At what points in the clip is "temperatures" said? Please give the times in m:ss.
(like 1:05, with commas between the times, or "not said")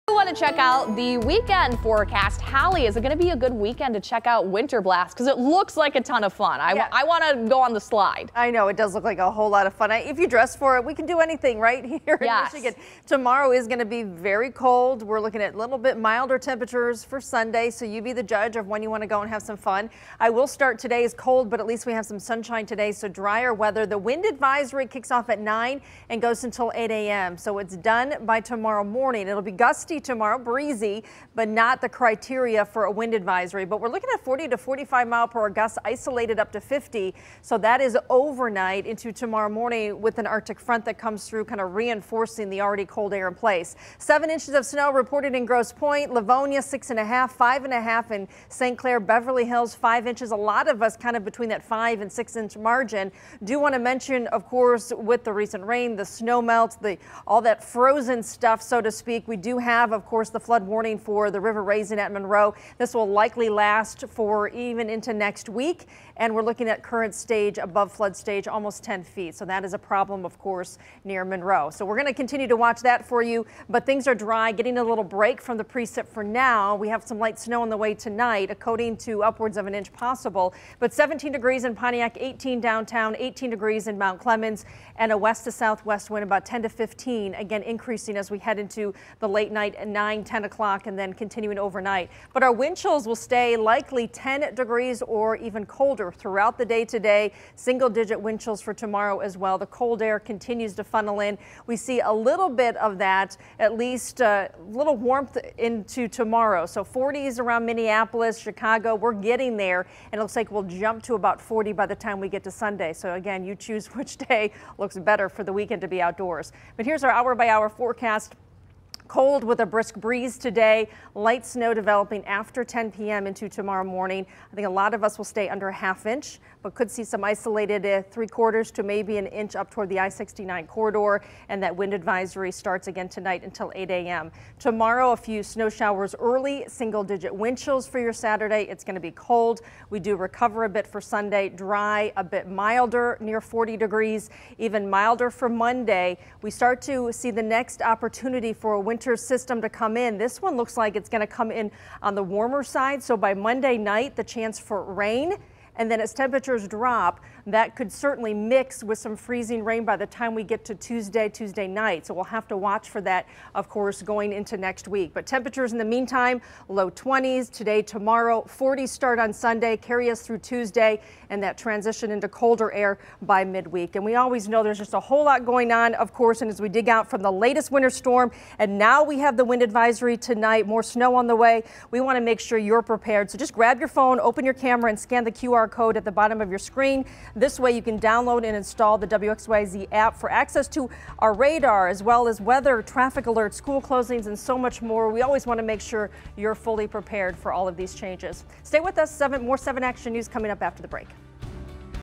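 0:16, 2:36, 2:45.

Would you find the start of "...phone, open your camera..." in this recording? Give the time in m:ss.
3:03.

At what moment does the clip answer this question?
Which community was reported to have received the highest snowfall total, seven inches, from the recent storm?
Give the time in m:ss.
0:45.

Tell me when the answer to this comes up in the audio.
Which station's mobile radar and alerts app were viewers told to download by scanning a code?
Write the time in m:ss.
3:09.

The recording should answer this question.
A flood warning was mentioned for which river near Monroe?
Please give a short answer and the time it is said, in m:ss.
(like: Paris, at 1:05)
River Raisin, at 1:01.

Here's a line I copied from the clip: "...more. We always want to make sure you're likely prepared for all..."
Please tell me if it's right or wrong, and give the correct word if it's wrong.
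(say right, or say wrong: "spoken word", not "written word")
wrong: "fully", not "likely".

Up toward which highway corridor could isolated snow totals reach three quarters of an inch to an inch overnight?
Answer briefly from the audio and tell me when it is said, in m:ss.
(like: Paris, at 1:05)
I-69, at 2:09.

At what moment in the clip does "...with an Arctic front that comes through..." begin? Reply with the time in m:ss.
0:39.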